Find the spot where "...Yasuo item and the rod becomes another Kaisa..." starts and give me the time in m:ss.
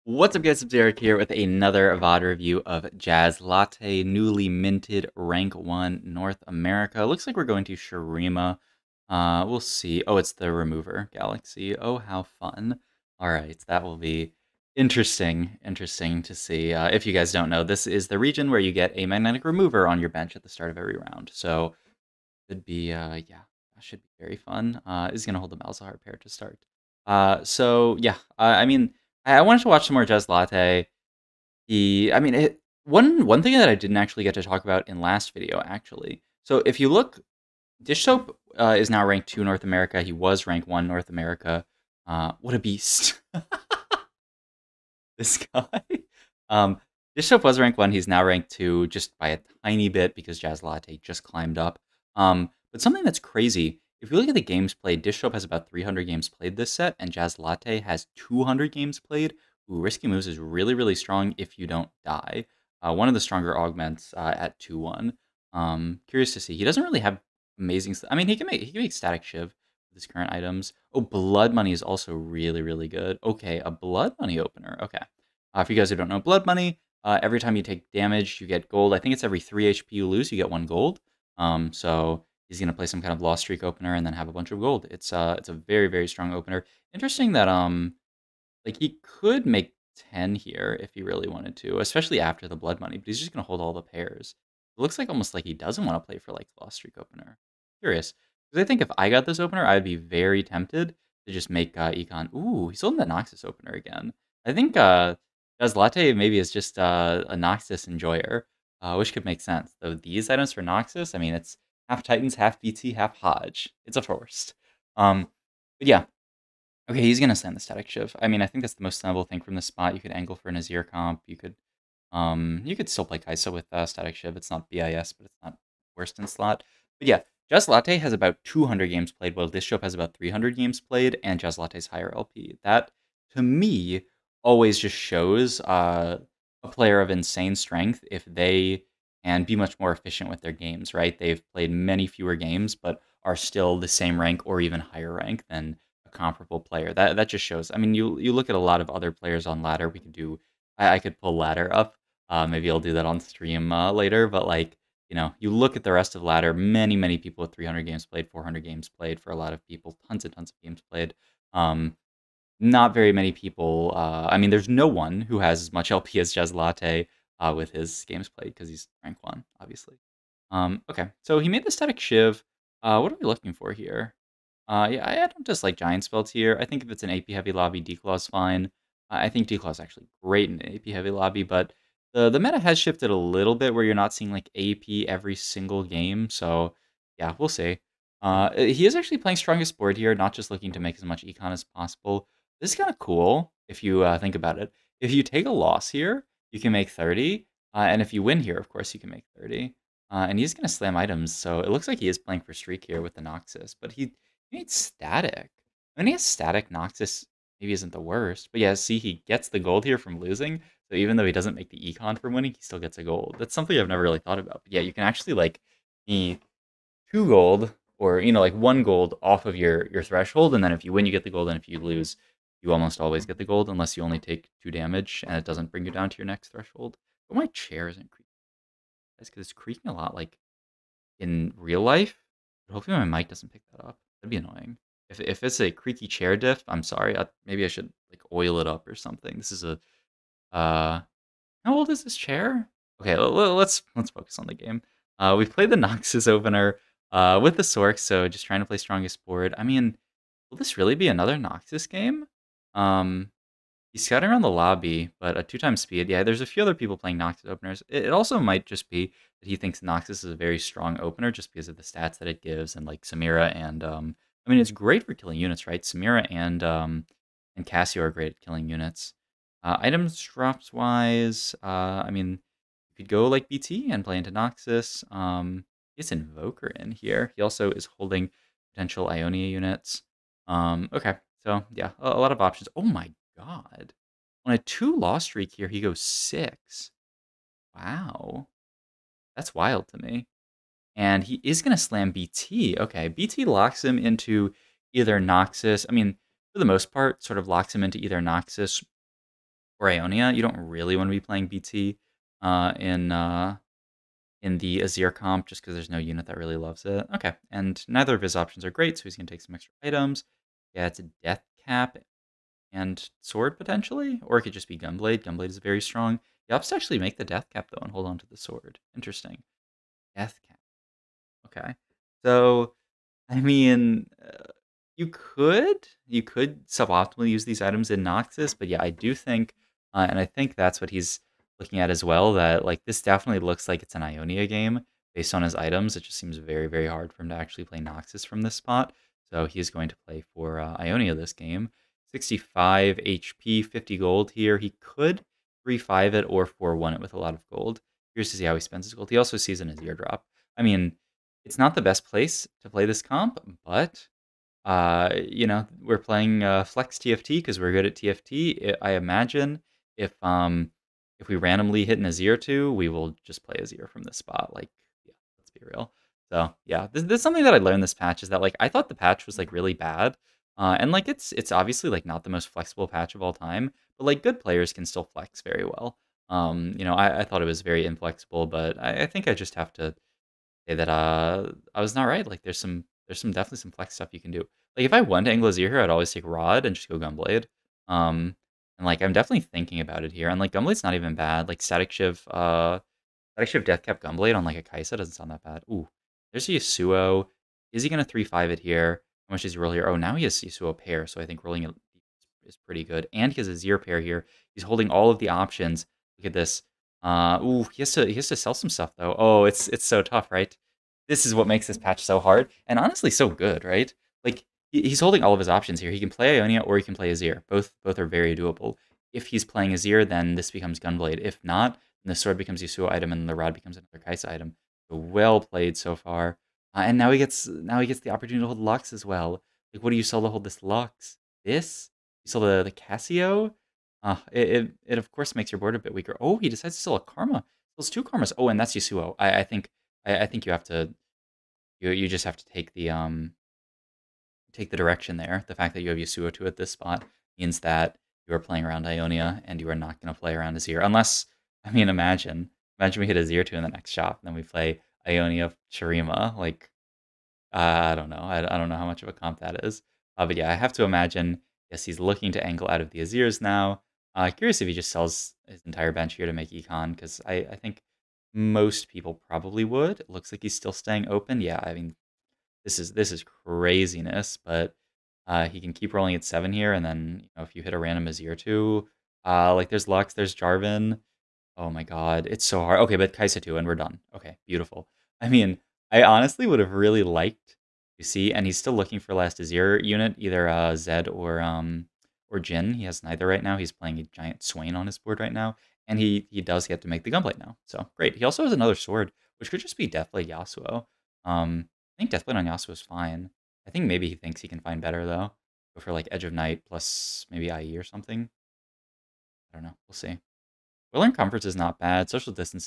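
7:02.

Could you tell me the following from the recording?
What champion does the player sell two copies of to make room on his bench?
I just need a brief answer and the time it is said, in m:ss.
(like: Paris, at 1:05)
Karma, at 7:17.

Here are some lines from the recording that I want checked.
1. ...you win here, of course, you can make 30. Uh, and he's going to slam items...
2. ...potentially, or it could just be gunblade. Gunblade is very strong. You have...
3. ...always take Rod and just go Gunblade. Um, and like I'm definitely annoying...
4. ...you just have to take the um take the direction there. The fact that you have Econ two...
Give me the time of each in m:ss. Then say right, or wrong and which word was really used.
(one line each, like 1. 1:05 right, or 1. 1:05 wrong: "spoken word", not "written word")
1. 3:18 right
2. 5:13 right
3. 6:25 wrong: "thinking", not "annoying"
4. 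7:21 wrong: "Yasuo", not "Econ".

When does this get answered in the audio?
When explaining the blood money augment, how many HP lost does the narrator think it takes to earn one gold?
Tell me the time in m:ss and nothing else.
1:19.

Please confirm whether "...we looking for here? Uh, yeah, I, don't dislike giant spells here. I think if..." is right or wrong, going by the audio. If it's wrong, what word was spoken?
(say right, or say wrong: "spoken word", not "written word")
right.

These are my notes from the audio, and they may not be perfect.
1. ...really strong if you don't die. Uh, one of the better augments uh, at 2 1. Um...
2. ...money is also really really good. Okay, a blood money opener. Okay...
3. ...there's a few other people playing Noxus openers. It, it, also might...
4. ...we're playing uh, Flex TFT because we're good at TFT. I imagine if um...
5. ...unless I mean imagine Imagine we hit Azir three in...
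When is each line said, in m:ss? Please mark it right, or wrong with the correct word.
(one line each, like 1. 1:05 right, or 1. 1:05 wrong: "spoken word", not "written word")
1. 1:00 wrong: "stronger", not "better"
2. 1:11 right
3. 4:16 right
4. 5:55 right
5. 7:30 wrong: "two", not "three".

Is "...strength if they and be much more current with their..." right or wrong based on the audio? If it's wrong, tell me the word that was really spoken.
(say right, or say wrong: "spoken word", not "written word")
wrong: "efficient", not "current".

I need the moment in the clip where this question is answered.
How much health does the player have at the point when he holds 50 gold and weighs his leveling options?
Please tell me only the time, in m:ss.
5:42.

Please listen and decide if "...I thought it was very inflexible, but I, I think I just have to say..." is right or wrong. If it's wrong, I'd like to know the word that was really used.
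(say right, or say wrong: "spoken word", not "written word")
right.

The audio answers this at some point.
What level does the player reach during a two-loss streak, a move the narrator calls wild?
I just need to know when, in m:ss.
4:45.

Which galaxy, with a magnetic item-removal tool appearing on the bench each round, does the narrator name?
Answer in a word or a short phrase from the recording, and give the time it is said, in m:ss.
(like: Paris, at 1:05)
Remover Galaxy, at 0:10.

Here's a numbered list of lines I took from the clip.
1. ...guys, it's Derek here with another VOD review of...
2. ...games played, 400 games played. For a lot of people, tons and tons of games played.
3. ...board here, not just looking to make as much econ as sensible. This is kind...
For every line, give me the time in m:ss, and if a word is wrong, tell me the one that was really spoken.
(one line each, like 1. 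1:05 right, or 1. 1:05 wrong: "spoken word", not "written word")
1. 0:00 right
2. 2:37 right
3. 3:09 wrong: "possible", not "sensible".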